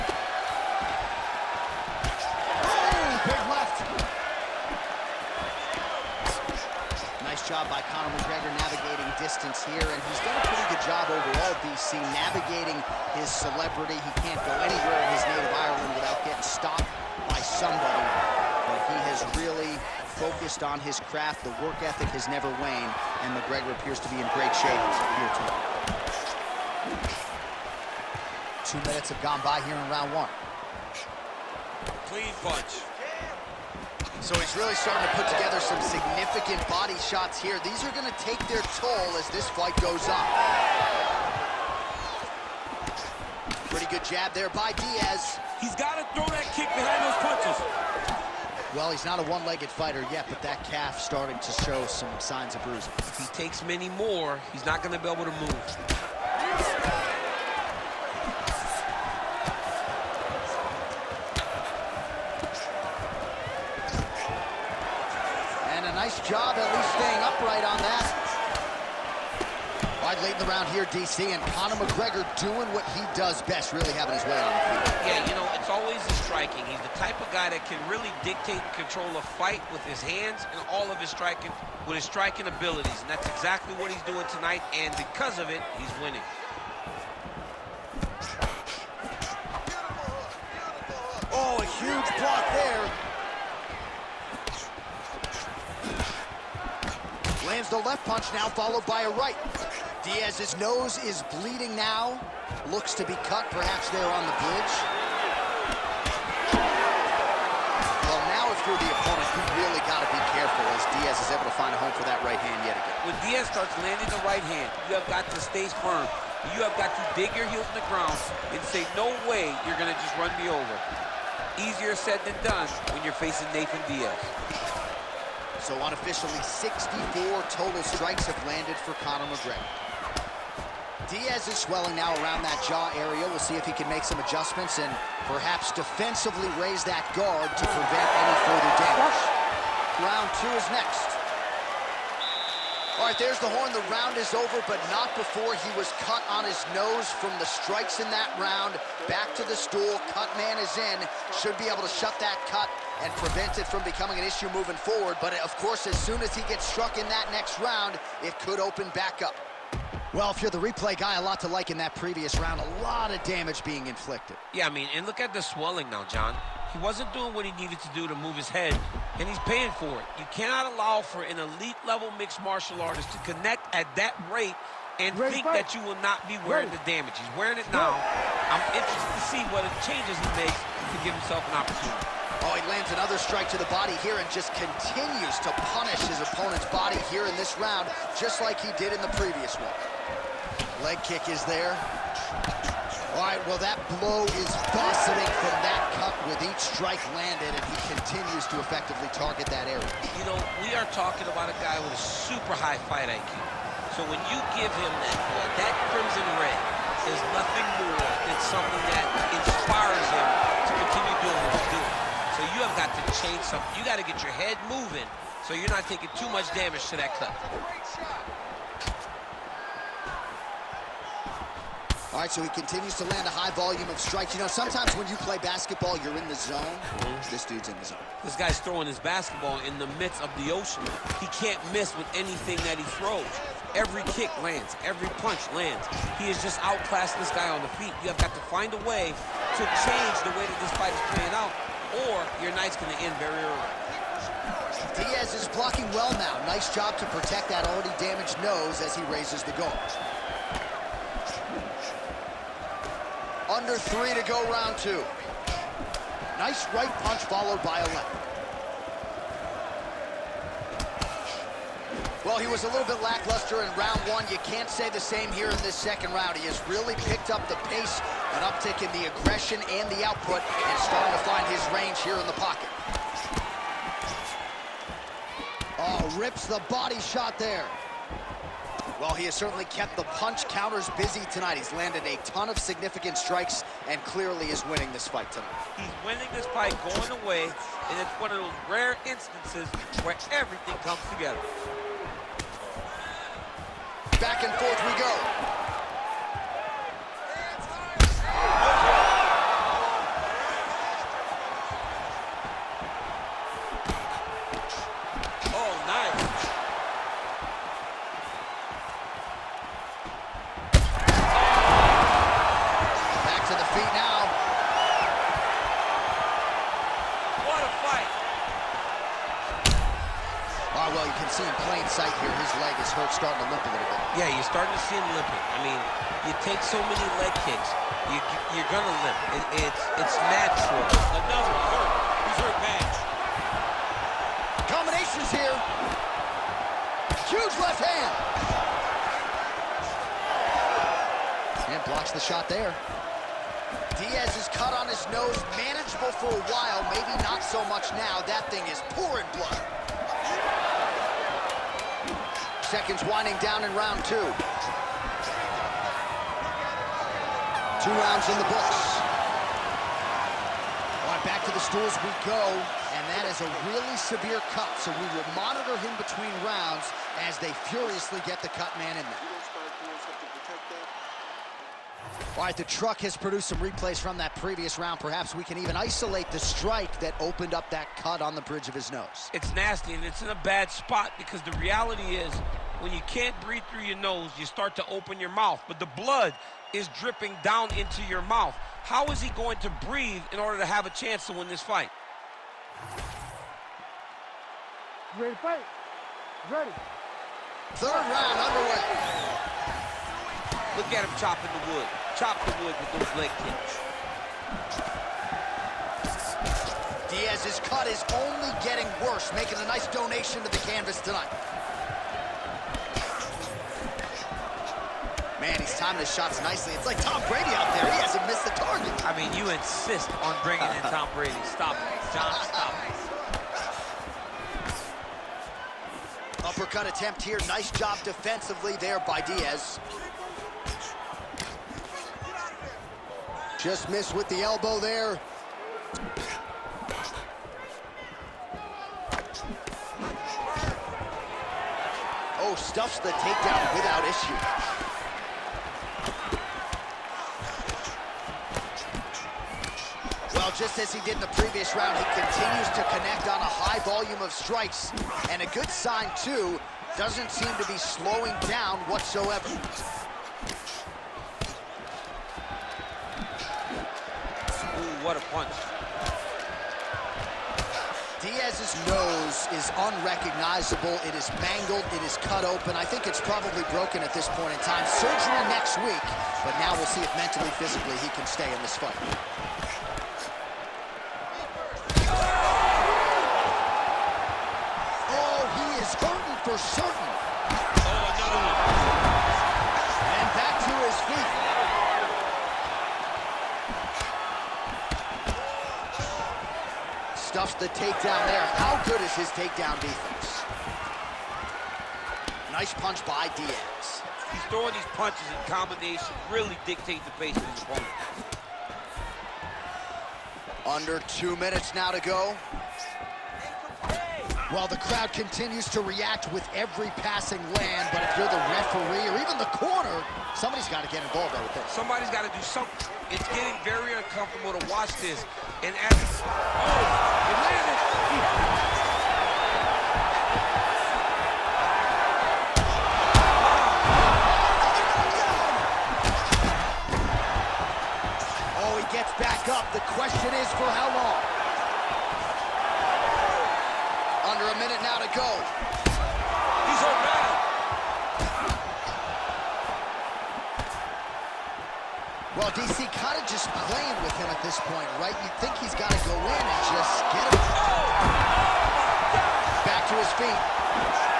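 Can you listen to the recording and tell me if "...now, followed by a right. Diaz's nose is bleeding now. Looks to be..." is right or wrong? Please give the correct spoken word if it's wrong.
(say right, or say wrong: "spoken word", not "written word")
right.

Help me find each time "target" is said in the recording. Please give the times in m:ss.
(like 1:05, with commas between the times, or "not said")
3:19, 6:58.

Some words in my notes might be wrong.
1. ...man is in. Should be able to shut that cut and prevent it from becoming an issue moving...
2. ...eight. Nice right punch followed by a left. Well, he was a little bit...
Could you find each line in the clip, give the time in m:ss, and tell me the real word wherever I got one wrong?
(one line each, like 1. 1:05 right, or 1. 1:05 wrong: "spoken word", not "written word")
1. 2:30 right
2. 4:14 wrong: "two", not "eight".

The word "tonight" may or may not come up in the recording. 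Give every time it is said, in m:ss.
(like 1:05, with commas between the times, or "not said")
0:25, 1:24, 4:41, 4:45, 6:51.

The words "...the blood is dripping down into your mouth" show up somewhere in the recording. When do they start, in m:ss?
6:25.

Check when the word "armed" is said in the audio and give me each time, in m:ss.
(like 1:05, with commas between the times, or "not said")
not said.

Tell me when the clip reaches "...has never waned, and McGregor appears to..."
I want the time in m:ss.
0:22.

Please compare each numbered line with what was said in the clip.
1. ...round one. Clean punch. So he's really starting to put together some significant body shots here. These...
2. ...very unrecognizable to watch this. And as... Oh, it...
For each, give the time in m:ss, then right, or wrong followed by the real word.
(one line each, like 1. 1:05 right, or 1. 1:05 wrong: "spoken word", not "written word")
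1. 0:29 right
2. 8:43 wrong: "uncomfortable", not "unrecognizable".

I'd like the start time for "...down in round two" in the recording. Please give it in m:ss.
5:53.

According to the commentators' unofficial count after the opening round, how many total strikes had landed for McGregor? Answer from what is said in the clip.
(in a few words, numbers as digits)
64.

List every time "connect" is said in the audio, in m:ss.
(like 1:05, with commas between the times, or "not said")
2:53, 7:32.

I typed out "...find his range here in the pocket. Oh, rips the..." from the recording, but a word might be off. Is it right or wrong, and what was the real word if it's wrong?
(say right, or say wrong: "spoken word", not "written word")
right.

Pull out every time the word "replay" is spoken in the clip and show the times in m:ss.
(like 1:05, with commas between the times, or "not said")
2:40, 6:13.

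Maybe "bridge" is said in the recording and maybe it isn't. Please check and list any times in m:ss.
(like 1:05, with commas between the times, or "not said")
1:44, 6:18.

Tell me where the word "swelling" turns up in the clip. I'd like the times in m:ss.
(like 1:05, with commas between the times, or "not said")
2:11, 2:45.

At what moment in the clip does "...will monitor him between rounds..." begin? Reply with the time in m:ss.
6:05.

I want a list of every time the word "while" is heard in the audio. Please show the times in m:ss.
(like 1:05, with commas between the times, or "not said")
5:46, 8:34.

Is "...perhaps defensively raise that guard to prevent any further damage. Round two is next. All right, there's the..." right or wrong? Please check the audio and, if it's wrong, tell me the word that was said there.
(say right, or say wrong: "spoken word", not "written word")
right.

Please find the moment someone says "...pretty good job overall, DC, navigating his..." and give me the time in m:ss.
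0:10.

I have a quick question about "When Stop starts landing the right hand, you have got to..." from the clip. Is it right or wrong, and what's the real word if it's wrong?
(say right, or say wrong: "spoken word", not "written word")
wrong: "Diaz", not "Stop".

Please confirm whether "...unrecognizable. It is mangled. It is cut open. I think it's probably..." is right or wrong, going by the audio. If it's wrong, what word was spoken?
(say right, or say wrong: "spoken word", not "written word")
right.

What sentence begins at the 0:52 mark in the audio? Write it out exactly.
If he takes many more, he's not going to be able to move.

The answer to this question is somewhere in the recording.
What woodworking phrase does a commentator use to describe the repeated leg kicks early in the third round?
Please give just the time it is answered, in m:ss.
6:41.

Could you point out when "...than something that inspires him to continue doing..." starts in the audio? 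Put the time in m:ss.
3:28.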